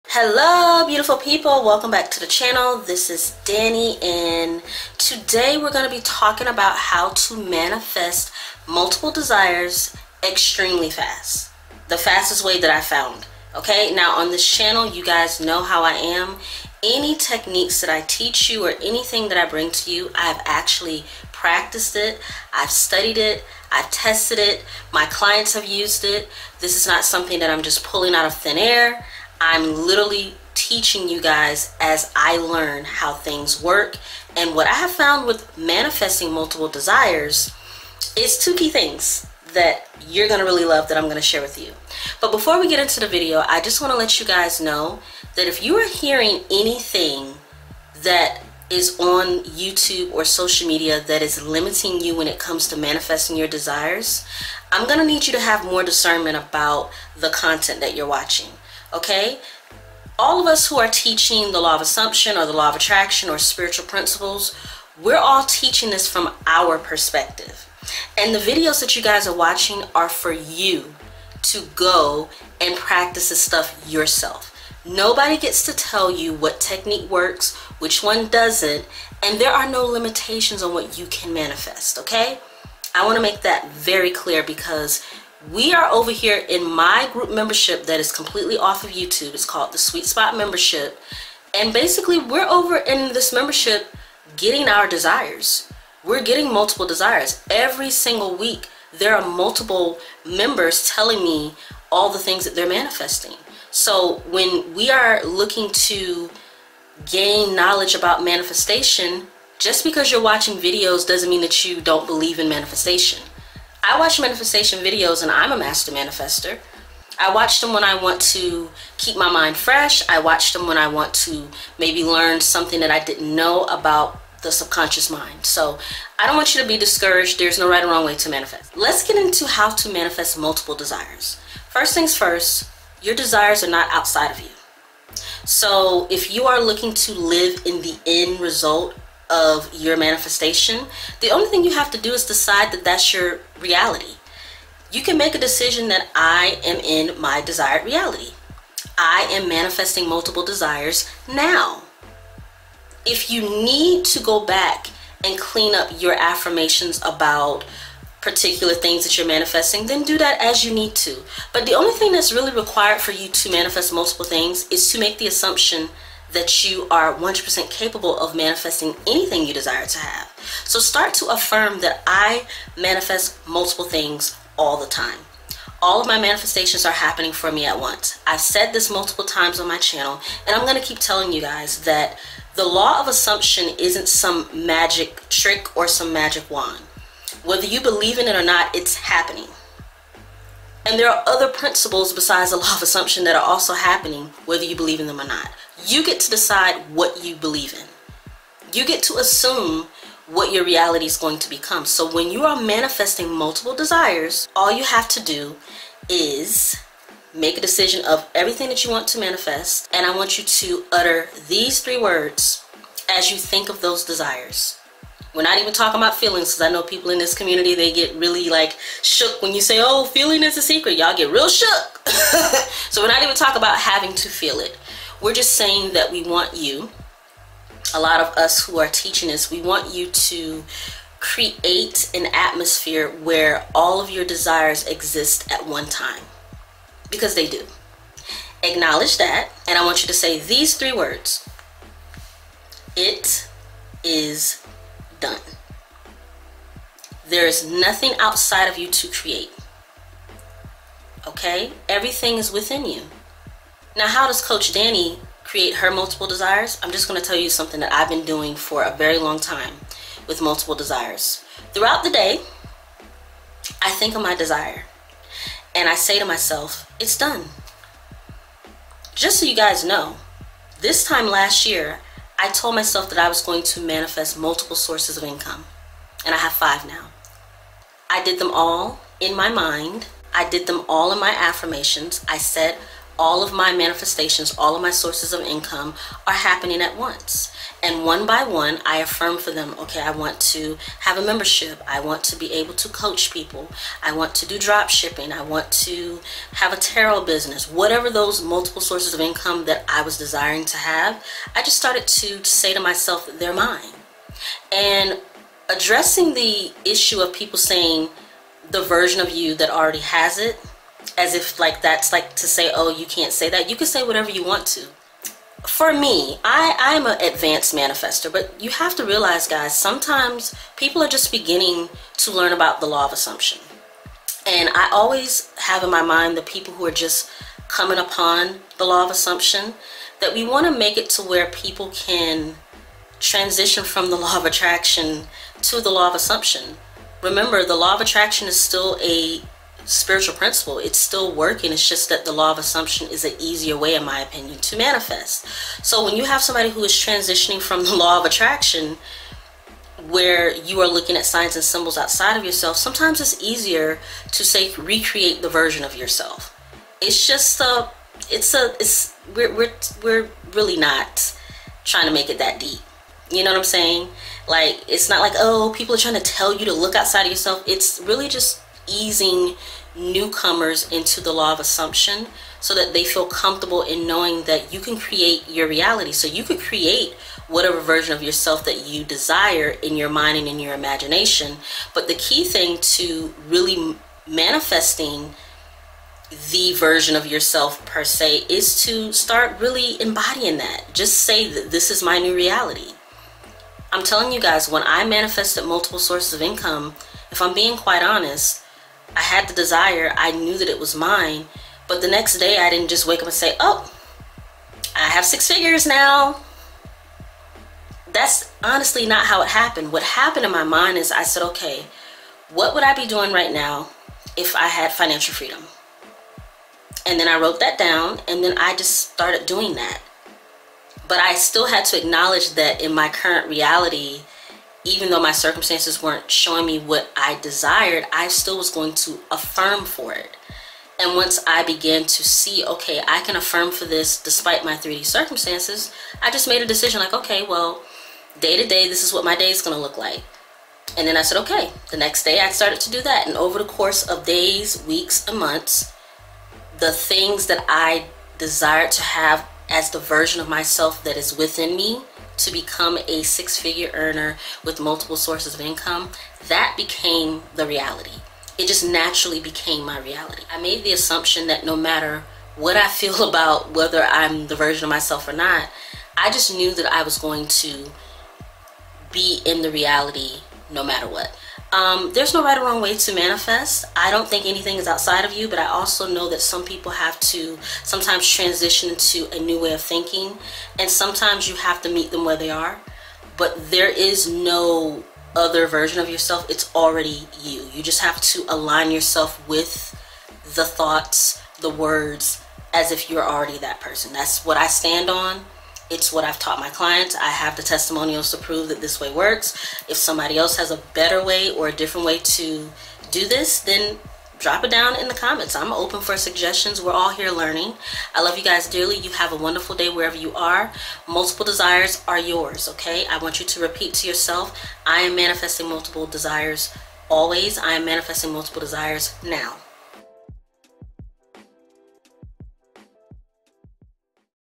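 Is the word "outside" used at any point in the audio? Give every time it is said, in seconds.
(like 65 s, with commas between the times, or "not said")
133 s, 248 s, 351 s, 366 s, 474 s.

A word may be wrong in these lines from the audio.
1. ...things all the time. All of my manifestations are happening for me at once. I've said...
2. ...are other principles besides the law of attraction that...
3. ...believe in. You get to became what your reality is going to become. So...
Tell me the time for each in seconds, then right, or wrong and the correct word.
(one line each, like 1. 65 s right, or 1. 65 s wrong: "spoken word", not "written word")
1. 173 s right
2. 191 s wrong: "assumption", not "attraction"
3. 197 s wrong: "assume", not "became".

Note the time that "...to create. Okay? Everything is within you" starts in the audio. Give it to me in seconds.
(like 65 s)
248 s.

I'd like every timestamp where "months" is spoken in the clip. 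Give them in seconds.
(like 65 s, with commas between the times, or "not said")
445 s.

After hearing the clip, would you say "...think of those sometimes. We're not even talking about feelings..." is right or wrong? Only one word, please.
wrong.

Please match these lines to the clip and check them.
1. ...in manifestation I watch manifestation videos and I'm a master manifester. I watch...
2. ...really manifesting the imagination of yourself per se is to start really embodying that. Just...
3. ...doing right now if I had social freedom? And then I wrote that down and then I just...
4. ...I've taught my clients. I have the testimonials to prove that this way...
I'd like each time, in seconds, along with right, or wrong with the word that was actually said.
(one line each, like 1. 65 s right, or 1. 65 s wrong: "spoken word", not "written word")
1. 112 s right
2. 383 s wrong: "version", not "imagination"
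3. 413 s wrong: "financial", not "social"
4. 496 s right.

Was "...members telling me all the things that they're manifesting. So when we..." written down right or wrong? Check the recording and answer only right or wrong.
right.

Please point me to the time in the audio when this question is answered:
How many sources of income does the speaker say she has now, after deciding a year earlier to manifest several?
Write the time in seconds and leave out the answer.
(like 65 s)
276 s.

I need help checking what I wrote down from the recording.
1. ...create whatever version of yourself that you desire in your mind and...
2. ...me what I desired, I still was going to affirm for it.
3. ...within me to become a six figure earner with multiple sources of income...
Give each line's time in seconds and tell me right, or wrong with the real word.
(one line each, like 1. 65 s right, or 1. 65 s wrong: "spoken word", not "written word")
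1. 376 s right
2. 426 s right
3. 451 s right.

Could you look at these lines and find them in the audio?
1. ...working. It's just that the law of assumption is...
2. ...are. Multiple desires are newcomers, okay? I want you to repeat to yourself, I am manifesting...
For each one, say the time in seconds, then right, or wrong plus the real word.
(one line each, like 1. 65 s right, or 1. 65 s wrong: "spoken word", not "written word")
1. 341 s right
2. 510 s wrong: "yours", not "newcomers".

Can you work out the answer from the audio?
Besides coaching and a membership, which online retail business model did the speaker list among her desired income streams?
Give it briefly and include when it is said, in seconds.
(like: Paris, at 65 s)
drop shipping, at 294 s.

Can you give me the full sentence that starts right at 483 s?
But there is no other version of yourself, it's already you.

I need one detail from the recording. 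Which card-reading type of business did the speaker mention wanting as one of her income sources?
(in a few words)
tarot business.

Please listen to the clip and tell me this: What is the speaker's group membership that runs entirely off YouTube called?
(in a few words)
Sweet Spot Membership.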